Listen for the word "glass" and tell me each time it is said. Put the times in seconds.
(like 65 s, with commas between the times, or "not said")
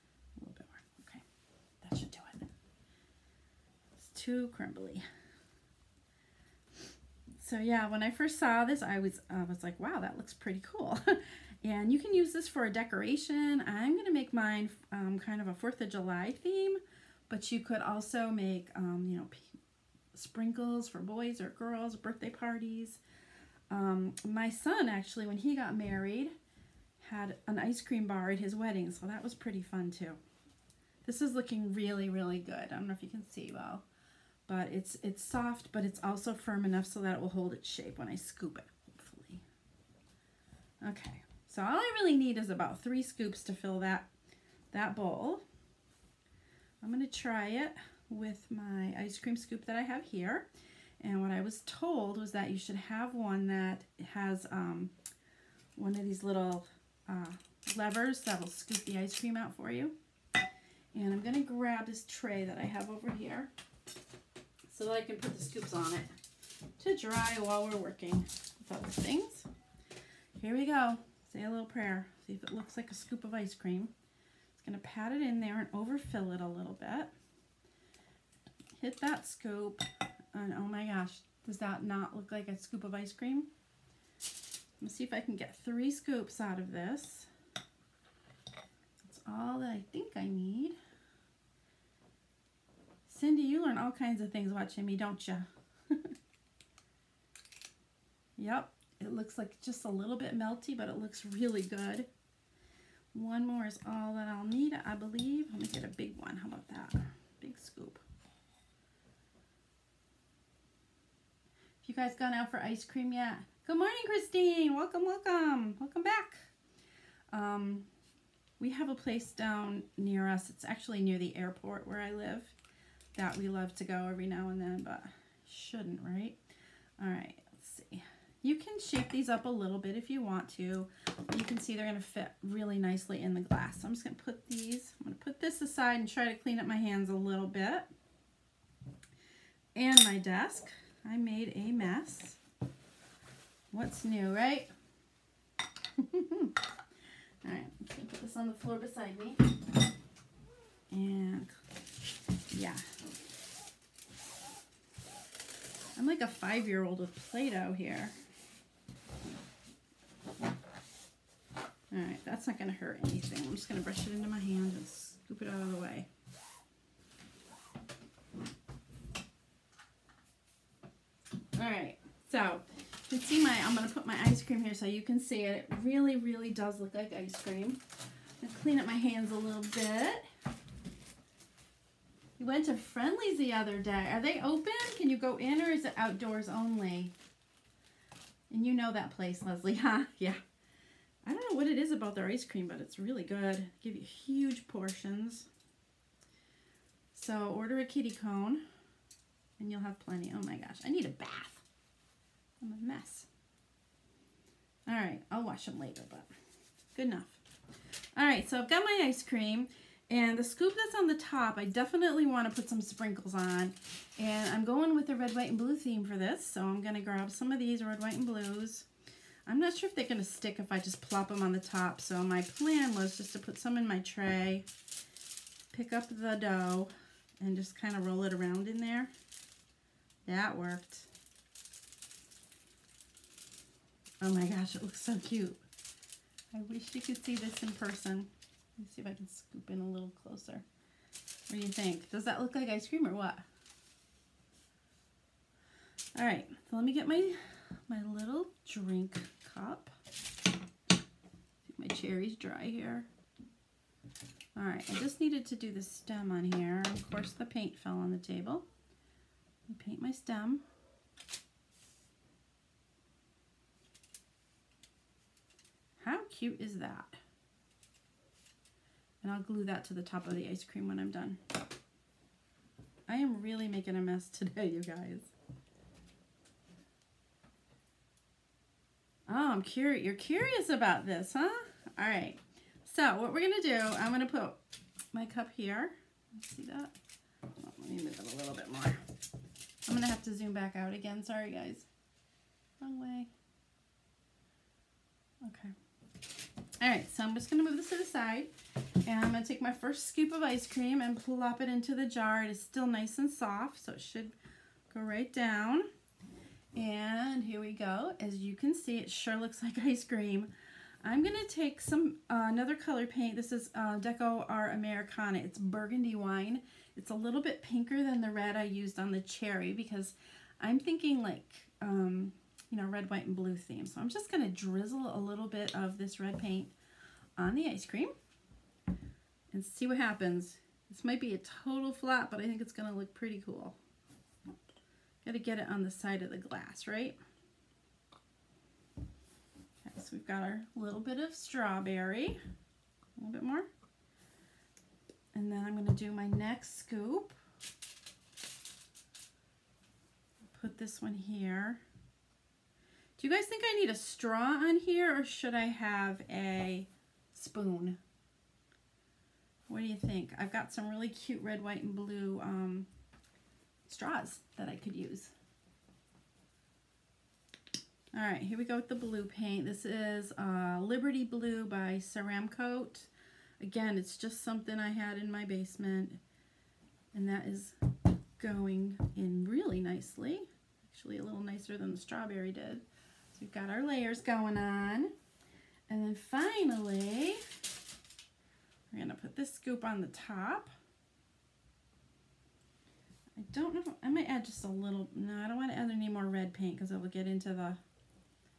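133 s, 336 s.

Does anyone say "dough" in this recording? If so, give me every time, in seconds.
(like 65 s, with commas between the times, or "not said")
226 s.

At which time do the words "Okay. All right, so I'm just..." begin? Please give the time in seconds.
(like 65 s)
295 s.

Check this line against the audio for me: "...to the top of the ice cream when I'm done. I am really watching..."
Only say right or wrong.
wrong.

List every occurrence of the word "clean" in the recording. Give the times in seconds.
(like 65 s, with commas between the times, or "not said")
136 s, 178 s.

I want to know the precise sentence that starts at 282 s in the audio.
So what we're going to do, I'm going to put my cup here.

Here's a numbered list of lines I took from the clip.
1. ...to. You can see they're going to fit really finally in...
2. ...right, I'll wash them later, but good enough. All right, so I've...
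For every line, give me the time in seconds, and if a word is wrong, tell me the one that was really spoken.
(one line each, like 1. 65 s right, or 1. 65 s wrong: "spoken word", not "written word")
1. 130 s wrong: "nicely", not "finally"
2. 204 s right.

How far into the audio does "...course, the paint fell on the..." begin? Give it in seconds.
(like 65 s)
257 s.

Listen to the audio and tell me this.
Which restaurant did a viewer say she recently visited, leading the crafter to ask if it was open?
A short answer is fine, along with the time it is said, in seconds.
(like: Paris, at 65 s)
Friendly's, at 182 s.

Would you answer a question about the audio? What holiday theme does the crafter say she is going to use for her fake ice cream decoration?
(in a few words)
4th of July.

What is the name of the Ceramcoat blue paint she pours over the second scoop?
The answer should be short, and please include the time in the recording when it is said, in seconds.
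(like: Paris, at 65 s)
Liberty Blue, at 370 s.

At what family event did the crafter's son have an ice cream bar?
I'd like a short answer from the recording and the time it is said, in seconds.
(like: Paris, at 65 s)
His wedding, at 28 s.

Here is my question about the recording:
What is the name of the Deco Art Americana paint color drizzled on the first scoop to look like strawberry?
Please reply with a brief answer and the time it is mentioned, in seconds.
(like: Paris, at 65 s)
Burgundy wine, at 315 s.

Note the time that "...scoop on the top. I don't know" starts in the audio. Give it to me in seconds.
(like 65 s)
389 s.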